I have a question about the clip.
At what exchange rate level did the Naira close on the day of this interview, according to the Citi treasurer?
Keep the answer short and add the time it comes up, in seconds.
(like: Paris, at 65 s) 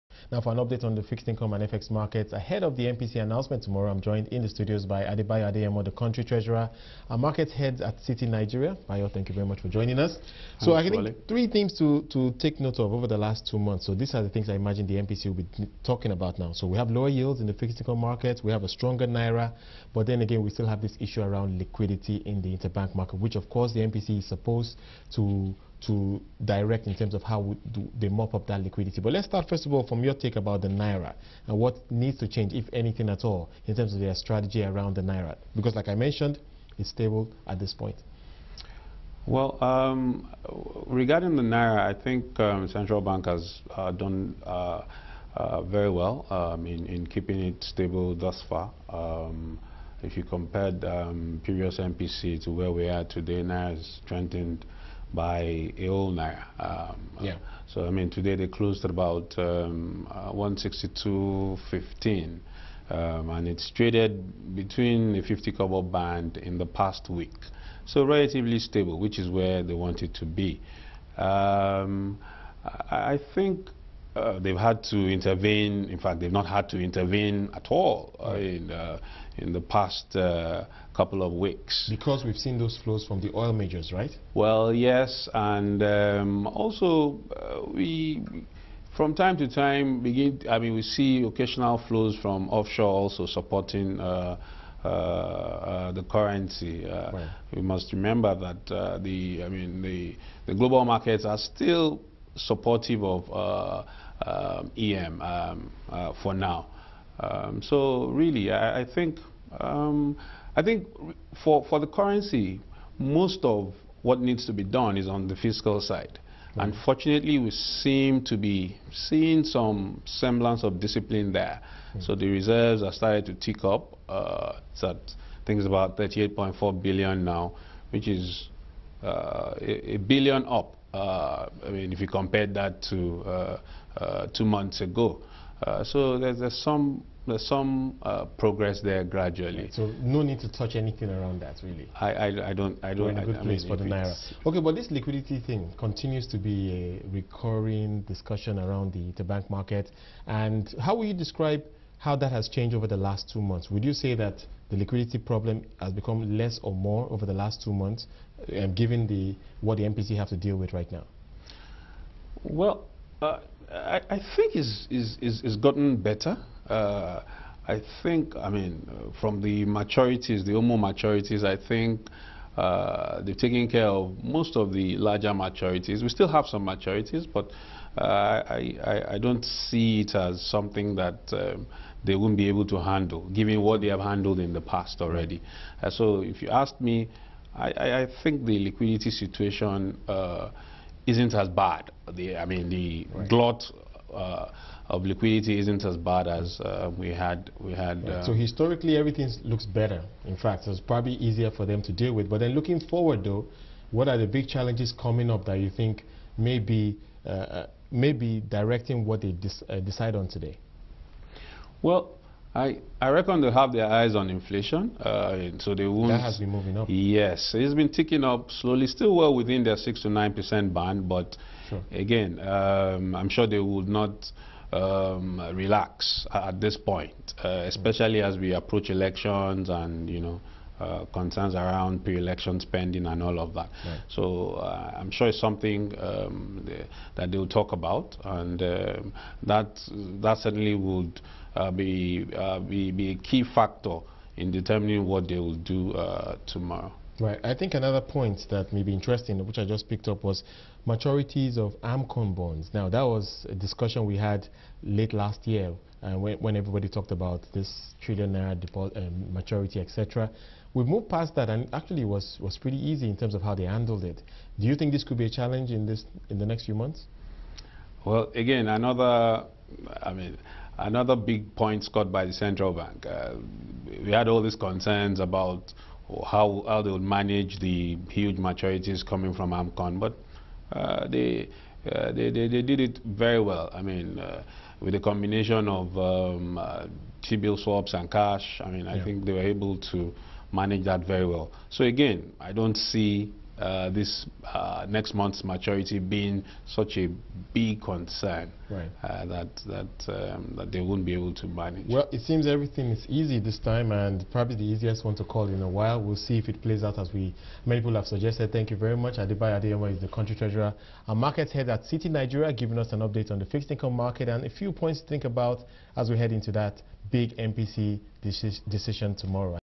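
162.15, at 60 s.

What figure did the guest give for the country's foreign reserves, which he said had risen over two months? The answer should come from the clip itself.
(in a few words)
38.4 billion.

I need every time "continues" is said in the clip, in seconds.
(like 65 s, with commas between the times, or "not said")
145 s.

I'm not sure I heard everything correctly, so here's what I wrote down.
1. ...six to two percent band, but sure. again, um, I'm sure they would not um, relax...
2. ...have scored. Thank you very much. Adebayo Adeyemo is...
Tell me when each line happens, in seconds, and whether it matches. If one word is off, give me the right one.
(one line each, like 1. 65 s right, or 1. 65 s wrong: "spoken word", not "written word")
1. 219 s wrong: "nine", not "two"
2. 307 s wrong: "suggested", not "scored".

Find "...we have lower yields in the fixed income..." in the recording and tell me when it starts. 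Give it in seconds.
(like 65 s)
16 s.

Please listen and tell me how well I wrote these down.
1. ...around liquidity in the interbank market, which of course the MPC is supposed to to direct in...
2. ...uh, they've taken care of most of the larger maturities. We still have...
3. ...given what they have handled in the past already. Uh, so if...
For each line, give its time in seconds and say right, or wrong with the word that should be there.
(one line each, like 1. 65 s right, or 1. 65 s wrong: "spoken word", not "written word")
1. 21 s right
2. 172 s right
3. 183 s right.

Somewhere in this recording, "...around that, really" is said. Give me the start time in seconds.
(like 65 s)
141 s.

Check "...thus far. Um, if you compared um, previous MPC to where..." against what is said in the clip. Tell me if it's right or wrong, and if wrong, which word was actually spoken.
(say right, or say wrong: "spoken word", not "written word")
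right.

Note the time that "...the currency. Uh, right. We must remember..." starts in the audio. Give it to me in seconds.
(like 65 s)
95 s.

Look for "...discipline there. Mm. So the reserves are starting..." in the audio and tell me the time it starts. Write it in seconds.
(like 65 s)
120 s.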